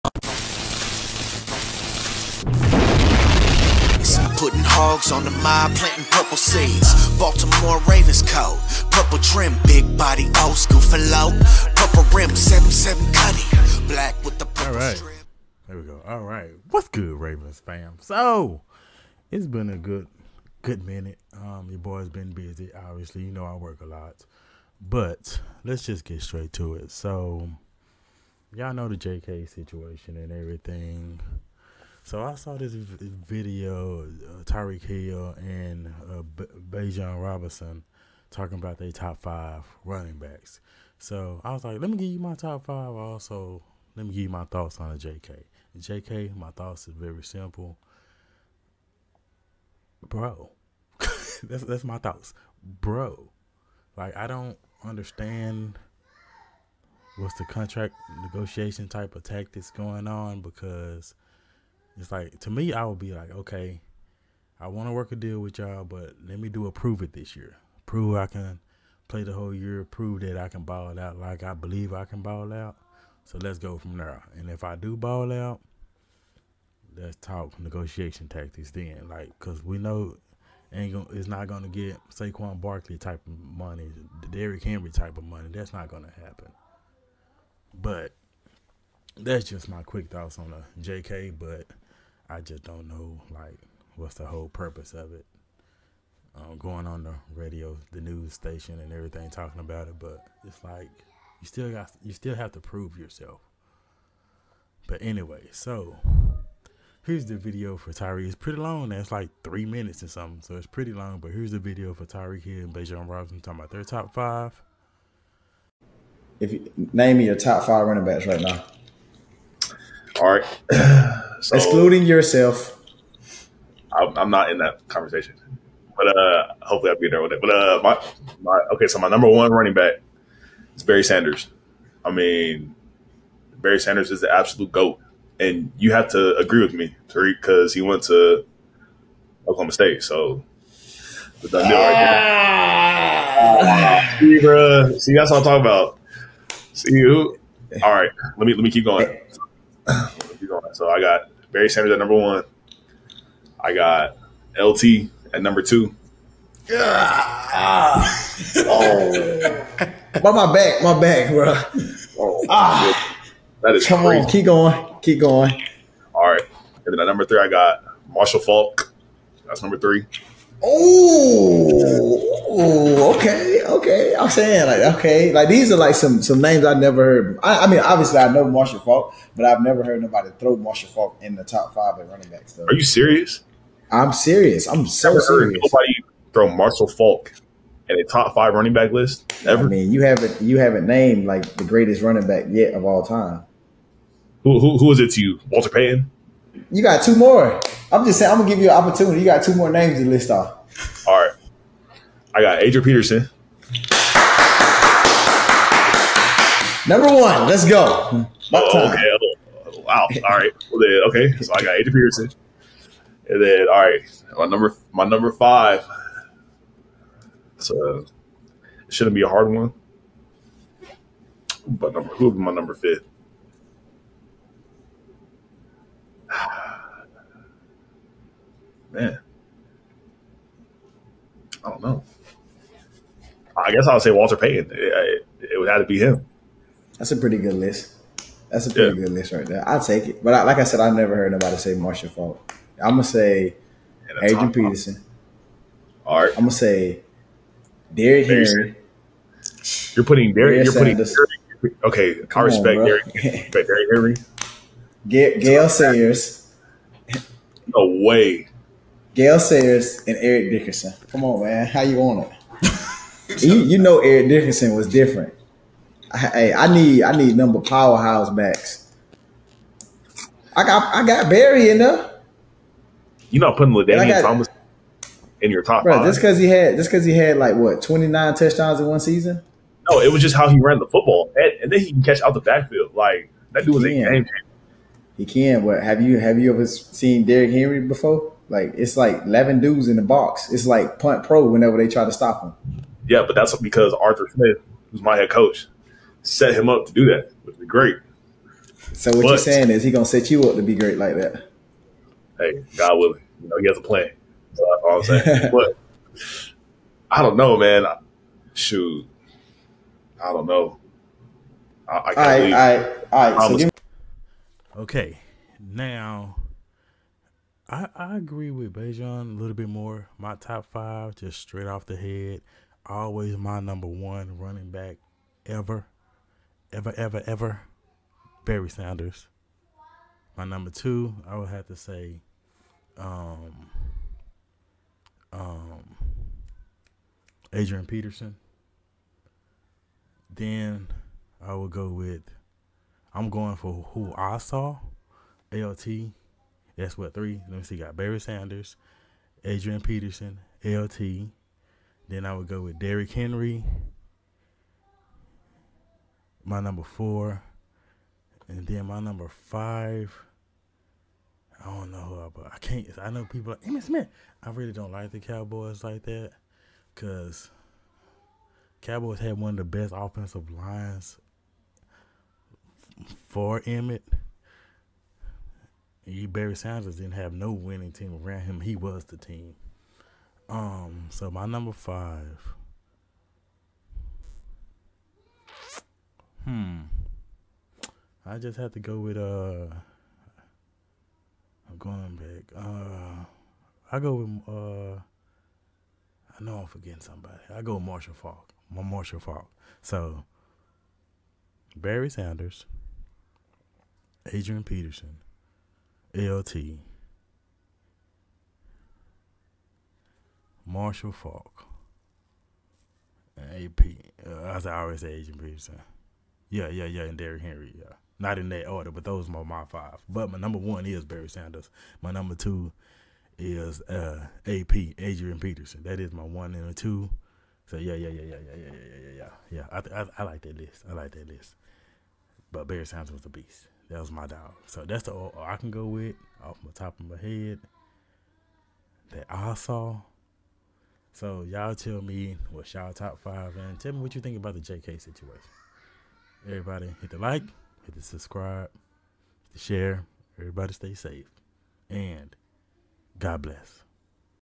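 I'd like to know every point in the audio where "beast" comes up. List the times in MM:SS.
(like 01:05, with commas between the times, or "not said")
07:13.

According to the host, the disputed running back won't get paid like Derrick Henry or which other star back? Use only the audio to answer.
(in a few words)
Saquon Barkley.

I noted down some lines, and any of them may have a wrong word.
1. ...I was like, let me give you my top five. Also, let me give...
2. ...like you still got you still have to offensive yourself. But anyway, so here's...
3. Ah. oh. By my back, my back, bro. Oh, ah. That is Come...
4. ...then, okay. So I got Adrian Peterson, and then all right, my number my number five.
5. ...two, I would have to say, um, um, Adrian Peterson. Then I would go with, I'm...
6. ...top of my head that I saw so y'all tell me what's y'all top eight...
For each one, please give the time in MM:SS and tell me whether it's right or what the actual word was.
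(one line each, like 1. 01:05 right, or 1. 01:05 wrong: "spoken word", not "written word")
1. 00:41 right
2. 01:40 wrong: "prove", not "offensive"
3. 02:36 right
4. 03:30 right
5. 05:30 right
6. 07:16 wrong: "five", not "eight".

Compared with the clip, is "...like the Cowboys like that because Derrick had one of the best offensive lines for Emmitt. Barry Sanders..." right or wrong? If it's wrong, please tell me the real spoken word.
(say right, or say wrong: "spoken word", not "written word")
wrong: "Cowboys", not "Derrick".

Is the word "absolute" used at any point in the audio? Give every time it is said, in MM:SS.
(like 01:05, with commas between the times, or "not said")
02:14.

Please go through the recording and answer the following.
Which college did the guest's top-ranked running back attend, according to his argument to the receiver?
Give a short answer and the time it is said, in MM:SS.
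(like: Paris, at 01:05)
Oklahoma State, at 02:19.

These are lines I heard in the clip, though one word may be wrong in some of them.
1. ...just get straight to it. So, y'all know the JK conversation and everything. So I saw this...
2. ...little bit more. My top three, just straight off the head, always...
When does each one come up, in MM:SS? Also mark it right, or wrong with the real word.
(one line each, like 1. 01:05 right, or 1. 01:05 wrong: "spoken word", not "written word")
1. 00:25 wrong: "situation", not "conversation"
2. 05:19 wrong: "five", not "three".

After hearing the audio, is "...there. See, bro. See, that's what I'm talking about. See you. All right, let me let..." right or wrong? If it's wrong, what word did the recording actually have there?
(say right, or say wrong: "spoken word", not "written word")
right.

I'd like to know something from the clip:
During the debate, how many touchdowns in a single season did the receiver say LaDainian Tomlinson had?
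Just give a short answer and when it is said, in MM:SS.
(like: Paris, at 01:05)
29, at 04:37.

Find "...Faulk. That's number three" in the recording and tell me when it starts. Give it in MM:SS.
02:48.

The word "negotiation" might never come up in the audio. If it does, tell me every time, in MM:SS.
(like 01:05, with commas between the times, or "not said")
00:58, 01:17.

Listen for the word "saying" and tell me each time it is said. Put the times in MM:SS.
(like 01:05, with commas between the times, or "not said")
02:54, 03:18, 04:59, 05:05.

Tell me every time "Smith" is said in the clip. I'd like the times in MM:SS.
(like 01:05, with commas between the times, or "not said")
04:54, 06:03.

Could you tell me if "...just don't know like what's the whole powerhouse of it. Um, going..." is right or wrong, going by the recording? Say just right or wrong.
wrong.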